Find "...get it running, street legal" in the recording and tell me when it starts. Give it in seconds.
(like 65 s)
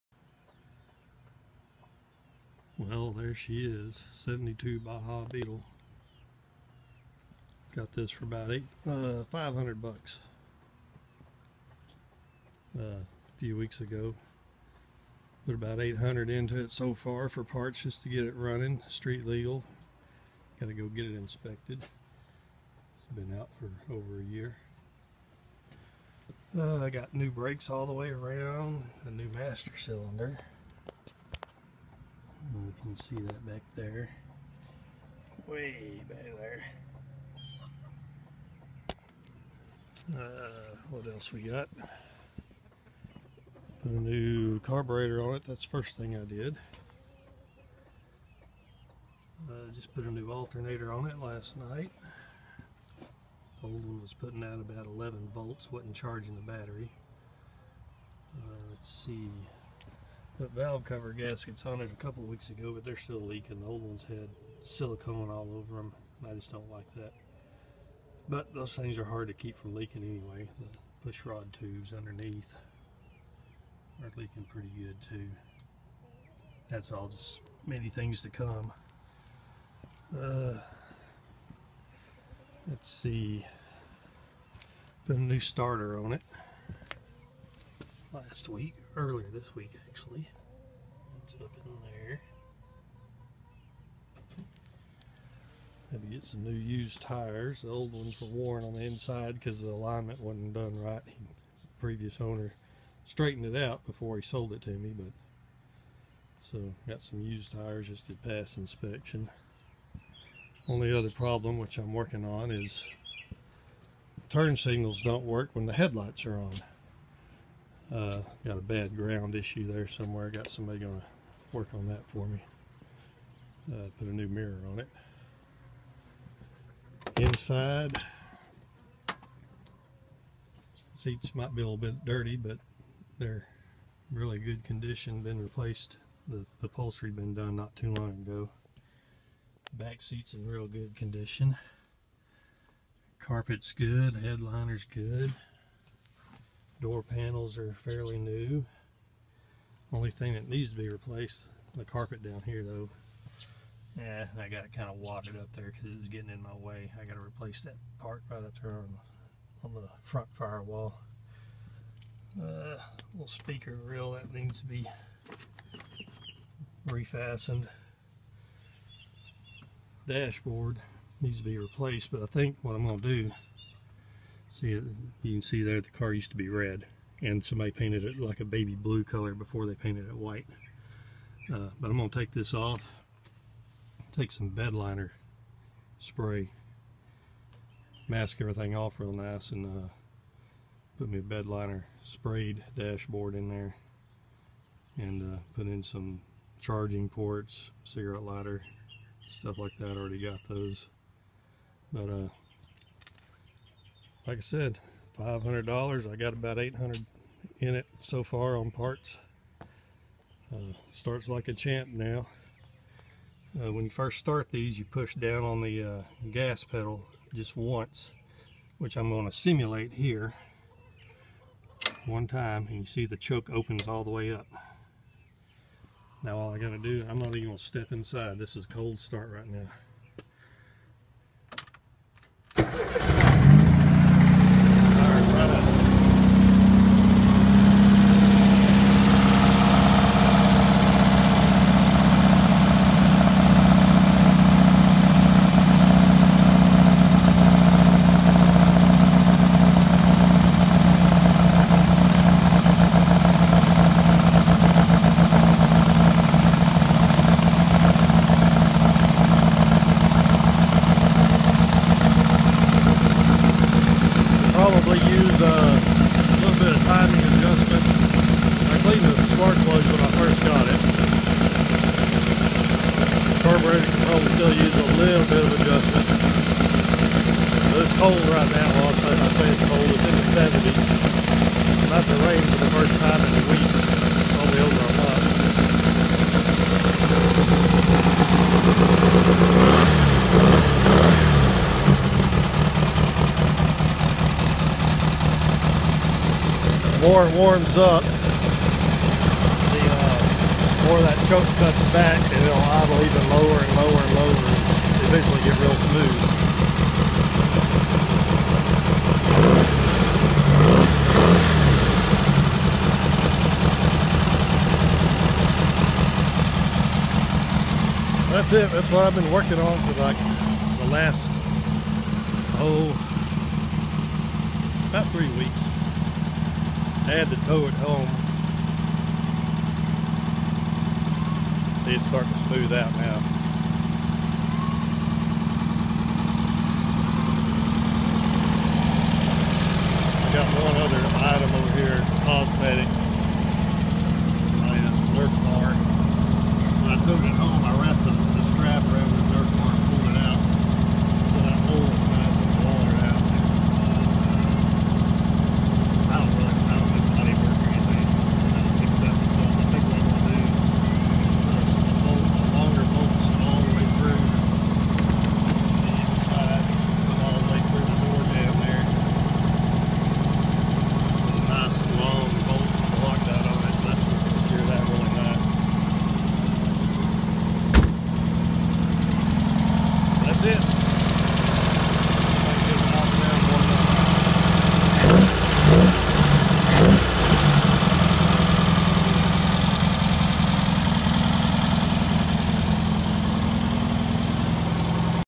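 18 s.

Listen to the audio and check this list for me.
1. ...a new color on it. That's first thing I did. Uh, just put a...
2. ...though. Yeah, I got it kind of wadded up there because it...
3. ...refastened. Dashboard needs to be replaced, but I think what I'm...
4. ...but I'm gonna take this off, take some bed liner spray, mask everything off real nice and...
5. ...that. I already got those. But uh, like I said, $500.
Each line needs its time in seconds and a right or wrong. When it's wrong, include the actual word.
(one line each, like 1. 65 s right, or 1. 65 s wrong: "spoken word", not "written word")
1. 43 s wrong: "carburetor", not "color"
2. 152 s right
3. 166 s right
4. 181 s right
5. 199 s right.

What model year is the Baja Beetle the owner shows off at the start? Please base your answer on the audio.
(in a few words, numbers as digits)
1972.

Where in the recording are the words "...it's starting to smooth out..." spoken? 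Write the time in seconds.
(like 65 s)
331 s.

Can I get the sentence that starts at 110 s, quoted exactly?
Only other problem which I'm working on is turn signals don't work when the headlights are on.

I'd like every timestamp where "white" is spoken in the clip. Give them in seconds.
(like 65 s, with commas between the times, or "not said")
180 s.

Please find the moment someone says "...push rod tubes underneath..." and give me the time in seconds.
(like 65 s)
71 s.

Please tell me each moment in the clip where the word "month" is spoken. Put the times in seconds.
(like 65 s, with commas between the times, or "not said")
284 s.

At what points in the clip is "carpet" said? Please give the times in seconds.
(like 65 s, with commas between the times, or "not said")
143 s, 151 s.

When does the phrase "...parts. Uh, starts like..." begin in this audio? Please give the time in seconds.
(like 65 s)
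208 s.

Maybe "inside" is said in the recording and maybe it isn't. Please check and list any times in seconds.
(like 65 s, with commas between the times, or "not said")
98 s, 127 s, 227 s.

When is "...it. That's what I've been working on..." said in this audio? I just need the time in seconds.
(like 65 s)
318 s.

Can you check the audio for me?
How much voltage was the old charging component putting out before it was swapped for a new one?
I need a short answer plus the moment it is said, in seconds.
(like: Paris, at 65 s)
11 volts, at 54 s.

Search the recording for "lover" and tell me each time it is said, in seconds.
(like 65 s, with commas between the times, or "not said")
not said.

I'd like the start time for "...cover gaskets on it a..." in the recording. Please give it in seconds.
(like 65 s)
60 s.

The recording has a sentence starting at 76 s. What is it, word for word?
That's all just many things to come.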